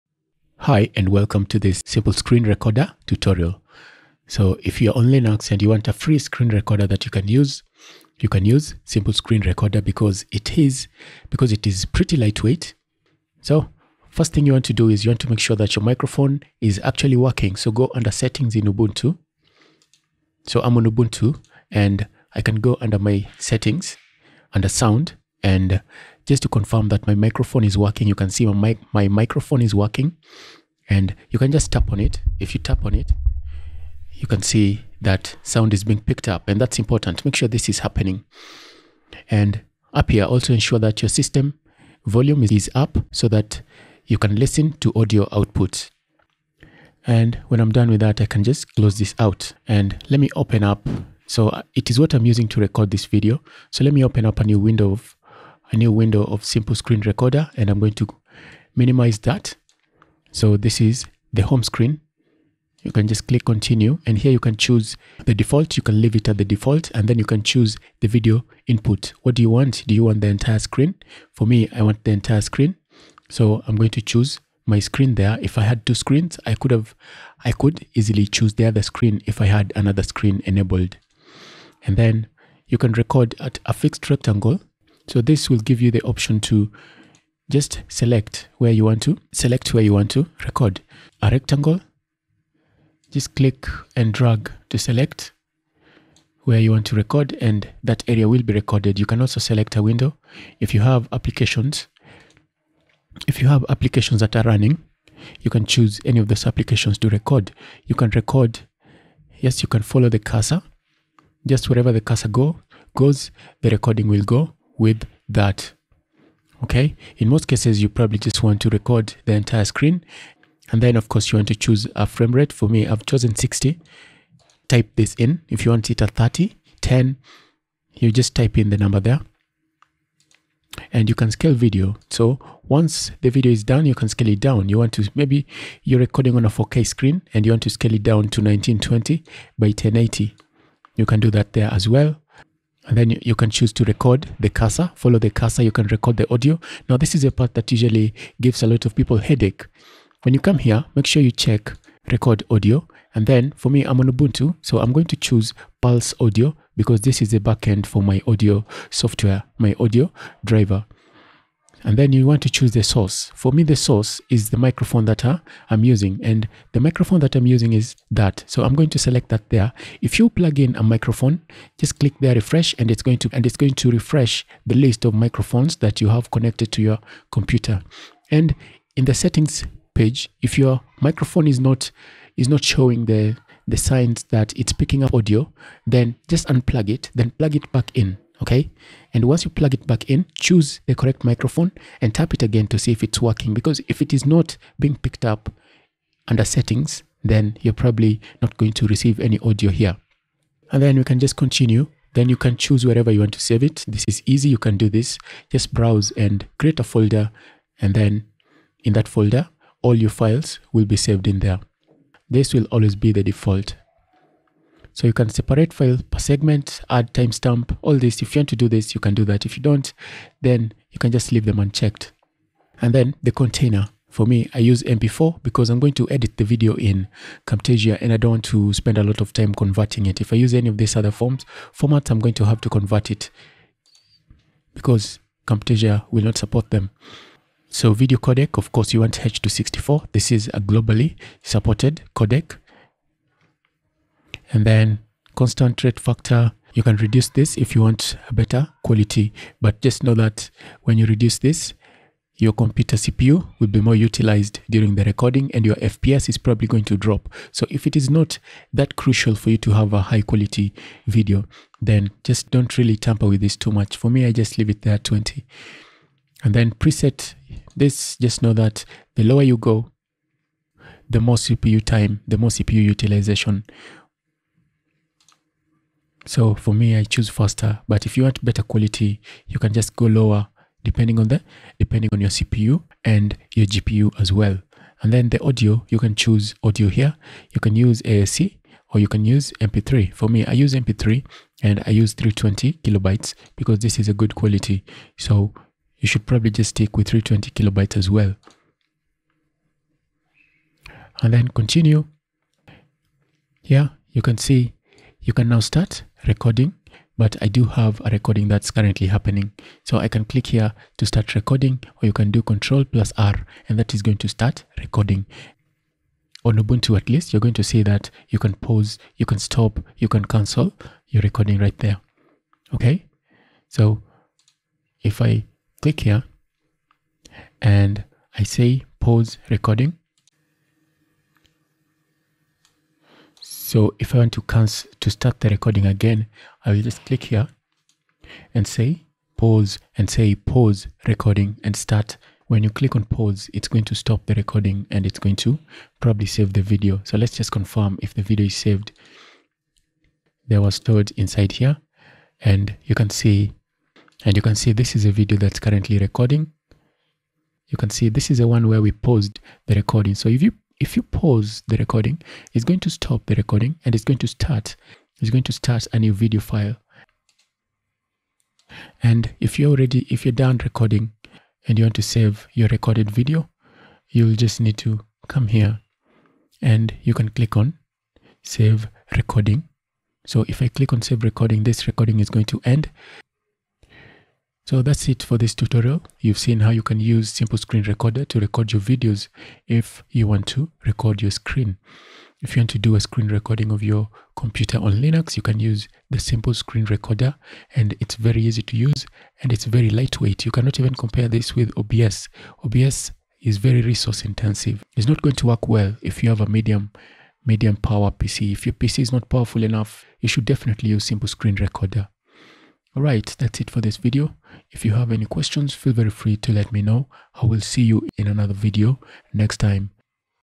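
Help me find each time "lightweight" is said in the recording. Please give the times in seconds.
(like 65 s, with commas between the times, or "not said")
12 s, 399 s.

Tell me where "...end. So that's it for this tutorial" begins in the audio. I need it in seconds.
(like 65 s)
382 s.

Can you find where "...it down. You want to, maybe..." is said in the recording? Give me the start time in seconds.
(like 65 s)
134 s.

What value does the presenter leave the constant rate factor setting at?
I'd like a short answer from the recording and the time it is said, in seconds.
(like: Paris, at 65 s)
20, at 265 s.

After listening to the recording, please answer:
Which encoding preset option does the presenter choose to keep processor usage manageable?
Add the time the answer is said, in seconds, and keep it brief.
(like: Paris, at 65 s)
faster, at 277 s.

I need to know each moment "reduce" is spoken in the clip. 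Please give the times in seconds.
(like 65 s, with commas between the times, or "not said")
246 s, 251 s.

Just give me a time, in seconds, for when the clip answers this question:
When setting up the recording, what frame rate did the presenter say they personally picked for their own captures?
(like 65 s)
123 s.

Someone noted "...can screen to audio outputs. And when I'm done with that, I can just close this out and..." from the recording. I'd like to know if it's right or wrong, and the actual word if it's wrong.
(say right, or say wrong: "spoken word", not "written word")
wrong: "listen", not "screen".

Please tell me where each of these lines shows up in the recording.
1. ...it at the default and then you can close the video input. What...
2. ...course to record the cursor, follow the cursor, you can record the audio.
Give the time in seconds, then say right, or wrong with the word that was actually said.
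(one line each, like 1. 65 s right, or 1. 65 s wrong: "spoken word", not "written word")
1. 66 s wrong: "choose", not "close"
2. 143 s wrong: "choose", not "course".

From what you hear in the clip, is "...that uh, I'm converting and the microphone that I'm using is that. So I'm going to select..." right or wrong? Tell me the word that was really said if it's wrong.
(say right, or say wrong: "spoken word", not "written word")
wrong: "using", not "converting".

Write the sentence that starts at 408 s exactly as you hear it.
If your PC is not powerful enough, you should definitely use Simple Screen Recorder.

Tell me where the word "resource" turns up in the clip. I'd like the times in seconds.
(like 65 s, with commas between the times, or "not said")
403 s.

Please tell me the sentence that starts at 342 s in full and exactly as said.
When you click on pause, it's going to stop the recording and it's going to probably save the video.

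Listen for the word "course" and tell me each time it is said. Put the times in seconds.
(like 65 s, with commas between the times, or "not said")
121 s, 238 s.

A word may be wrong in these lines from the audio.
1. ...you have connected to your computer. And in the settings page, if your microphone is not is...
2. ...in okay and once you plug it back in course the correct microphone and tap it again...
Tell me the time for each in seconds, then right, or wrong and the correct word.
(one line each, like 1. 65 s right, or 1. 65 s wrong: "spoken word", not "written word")
1. 176 s right
2. 187 s wrong: "choose", not "course".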